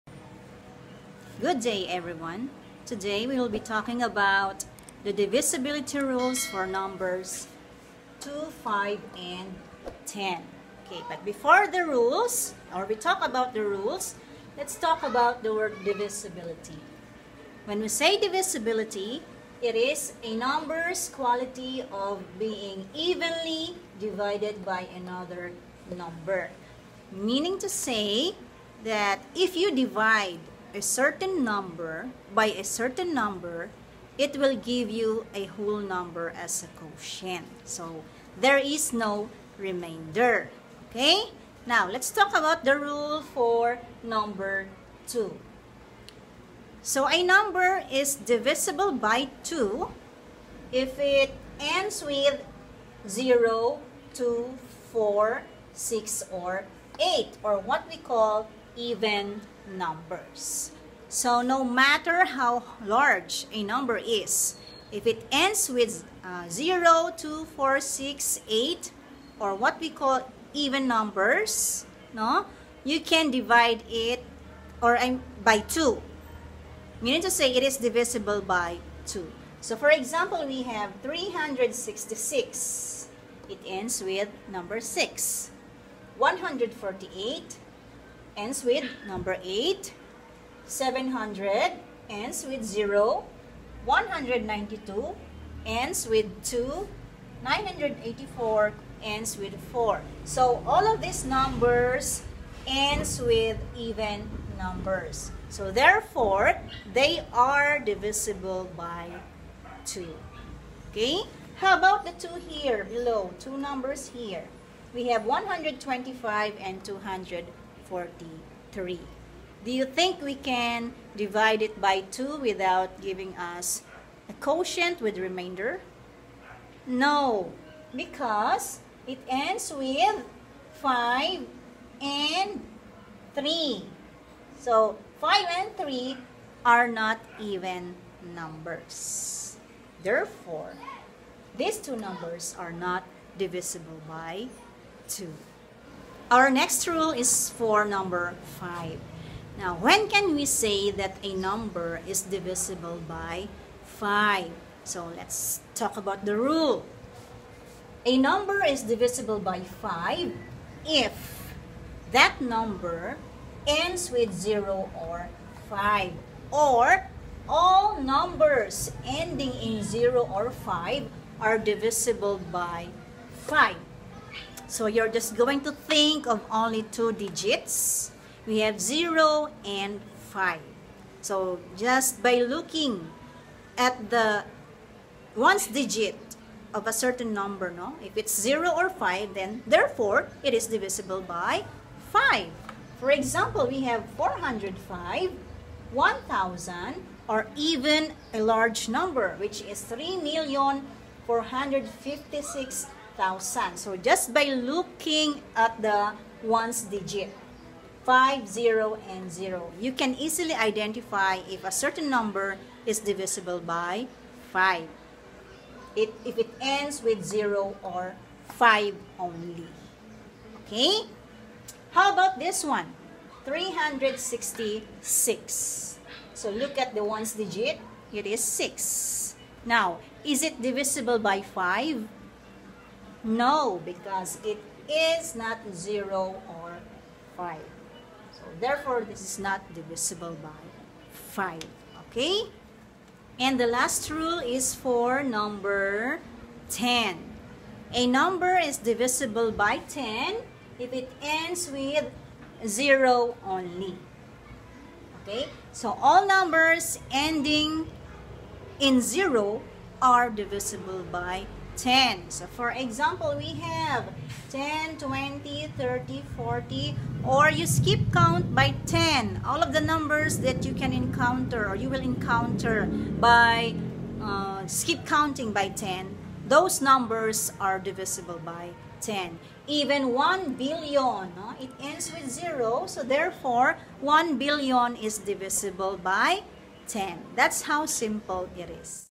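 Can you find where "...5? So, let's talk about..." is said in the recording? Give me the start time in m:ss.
2:33.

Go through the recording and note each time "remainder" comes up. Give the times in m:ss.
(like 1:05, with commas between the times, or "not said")
0:39, 2:05.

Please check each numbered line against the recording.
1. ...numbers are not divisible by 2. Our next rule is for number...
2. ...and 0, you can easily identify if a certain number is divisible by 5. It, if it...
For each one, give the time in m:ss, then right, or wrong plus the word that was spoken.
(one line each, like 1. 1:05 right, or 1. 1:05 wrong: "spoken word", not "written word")
1. 2:21 right
2. 3:29 right.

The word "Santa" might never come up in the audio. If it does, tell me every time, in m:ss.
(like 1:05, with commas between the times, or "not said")
not said.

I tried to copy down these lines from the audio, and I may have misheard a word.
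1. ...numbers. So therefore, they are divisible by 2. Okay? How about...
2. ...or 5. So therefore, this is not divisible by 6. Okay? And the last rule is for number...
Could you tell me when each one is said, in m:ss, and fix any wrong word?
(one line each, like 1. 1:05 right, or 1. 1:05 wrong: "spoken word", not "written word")
1. 1:44 right
2. 3:56 wrong: "5", not "6".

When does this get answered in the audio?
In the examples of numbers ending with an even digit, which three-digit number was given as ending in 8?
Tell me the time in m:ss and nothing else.
1:26.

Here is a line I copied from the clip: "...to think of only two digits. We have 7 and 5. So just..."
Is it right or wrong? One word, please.
wrong.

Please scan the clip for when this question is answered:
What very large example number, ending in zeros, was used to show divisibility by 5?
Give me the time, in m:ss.
3:19.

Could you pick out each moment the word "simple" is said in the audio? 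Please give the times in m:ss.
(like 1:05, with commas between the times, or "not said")
4:47.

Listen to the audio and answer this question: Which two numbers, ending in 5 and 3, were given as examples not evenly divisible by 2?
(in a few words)
125 and 243.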